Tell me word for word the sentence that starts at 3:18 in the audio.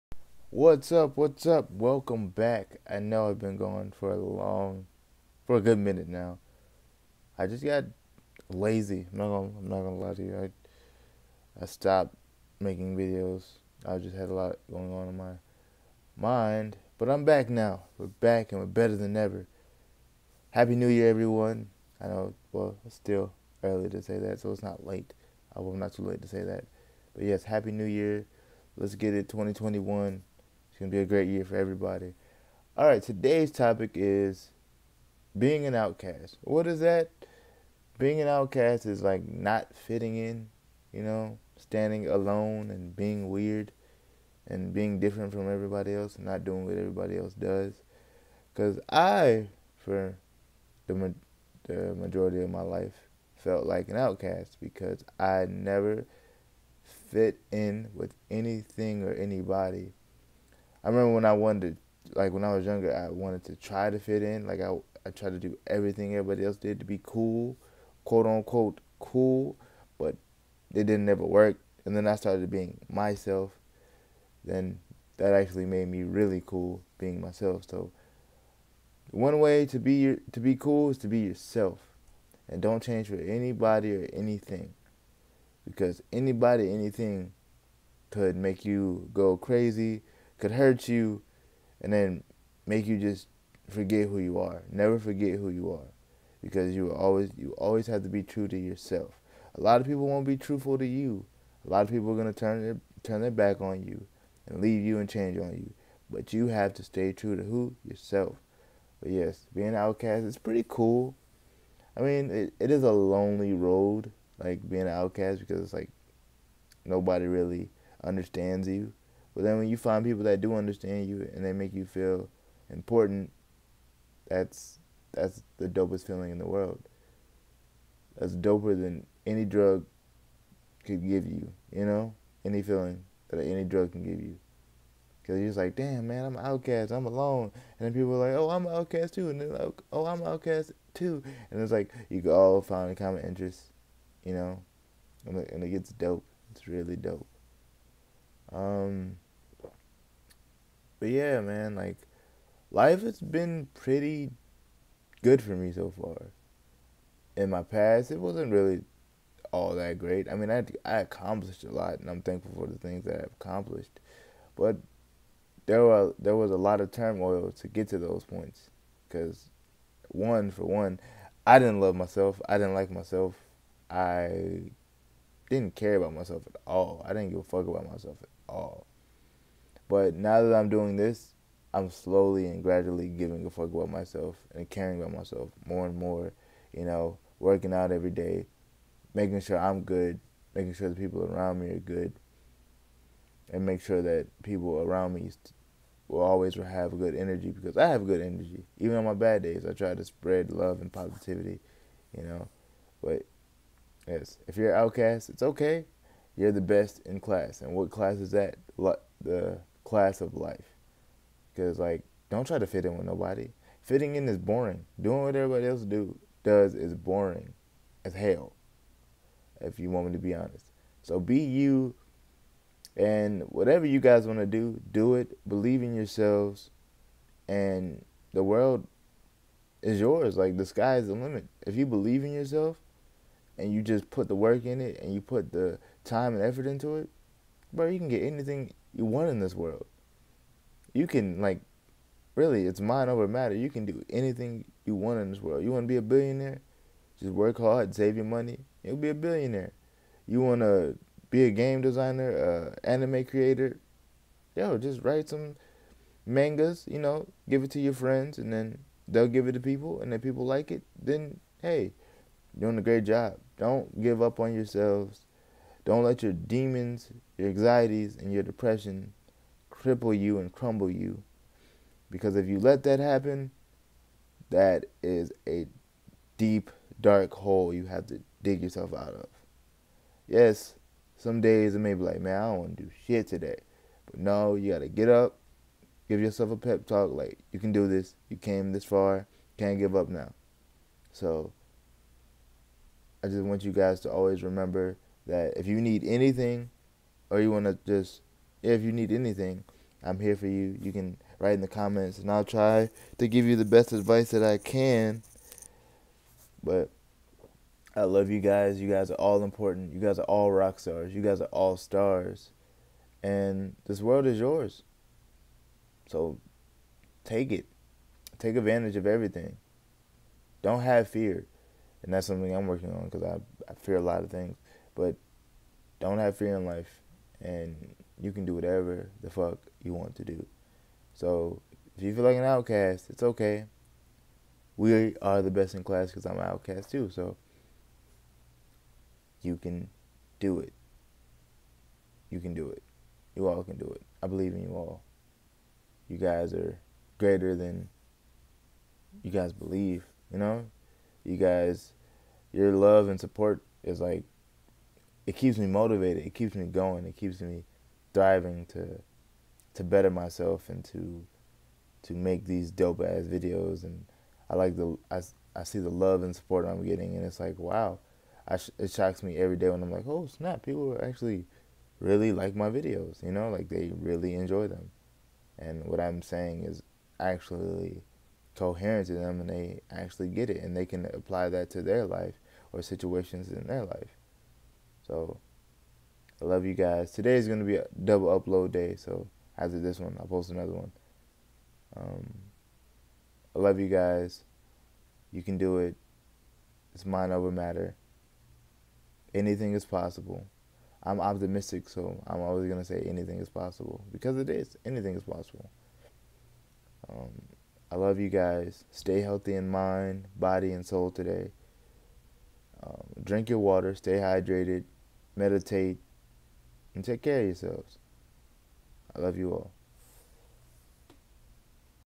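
Even on my bad days, I try to spread love and positivity, you know.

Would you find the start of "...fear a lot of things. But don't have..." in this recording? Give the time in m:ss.
5:23.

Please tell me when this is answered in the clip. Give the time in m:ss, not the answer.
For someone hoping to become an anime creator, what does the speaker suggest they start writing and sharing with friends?
4:16.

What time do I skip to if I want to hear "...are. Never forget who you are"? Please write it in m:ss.
1:34.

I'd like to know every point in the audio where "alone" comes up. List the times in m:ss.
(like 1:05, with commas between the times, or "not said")
0:42, 2:17.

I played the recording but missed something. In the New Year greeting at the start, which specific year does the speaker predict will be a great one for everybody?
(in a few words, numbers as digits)
2021.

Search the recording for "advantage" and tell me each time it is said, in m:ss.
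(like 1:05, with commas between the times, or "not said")
5:18.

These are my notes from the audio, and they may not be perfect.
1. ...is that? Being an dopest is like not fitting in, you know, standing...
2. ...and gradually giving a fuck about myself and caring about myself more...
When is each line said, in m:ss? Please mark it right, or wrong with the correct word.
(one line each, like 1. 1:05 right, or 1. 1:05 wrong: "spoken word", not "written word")
1. 0:36 wrong: "outcast", not "dopest"
2. 3:02 right.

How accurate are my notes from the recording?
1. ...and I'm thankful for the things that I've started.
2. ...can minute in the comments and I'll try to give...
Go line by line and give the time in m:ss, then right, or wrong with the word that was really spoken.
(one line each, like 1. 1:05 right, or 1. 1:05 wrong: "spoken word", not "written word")
1. 2:41 wrong: "accomplished", not "started"
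2. 5:00 wrong: "write", not "minute".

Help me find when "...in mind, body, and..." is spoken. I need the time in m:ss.
6:49.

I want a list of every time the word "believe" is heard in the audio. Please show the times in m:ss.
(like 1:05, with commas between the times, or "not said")
3:45, 3:51, 5:44, 5:49.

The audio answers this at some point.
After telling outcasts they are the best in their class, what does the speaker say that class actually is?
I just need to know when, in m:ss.
3:29.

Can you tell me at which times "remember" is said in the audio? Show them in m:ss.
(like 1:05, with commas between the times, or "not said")
1:00, 4:54.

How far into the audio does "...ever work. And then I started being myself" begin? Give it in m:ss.
1:11.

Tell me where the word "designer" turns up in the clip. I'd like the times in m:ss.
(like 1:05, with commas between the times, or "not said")
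4:11.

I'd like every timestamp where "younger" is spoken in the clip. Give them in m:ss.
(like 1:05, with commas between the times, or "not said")
1:02.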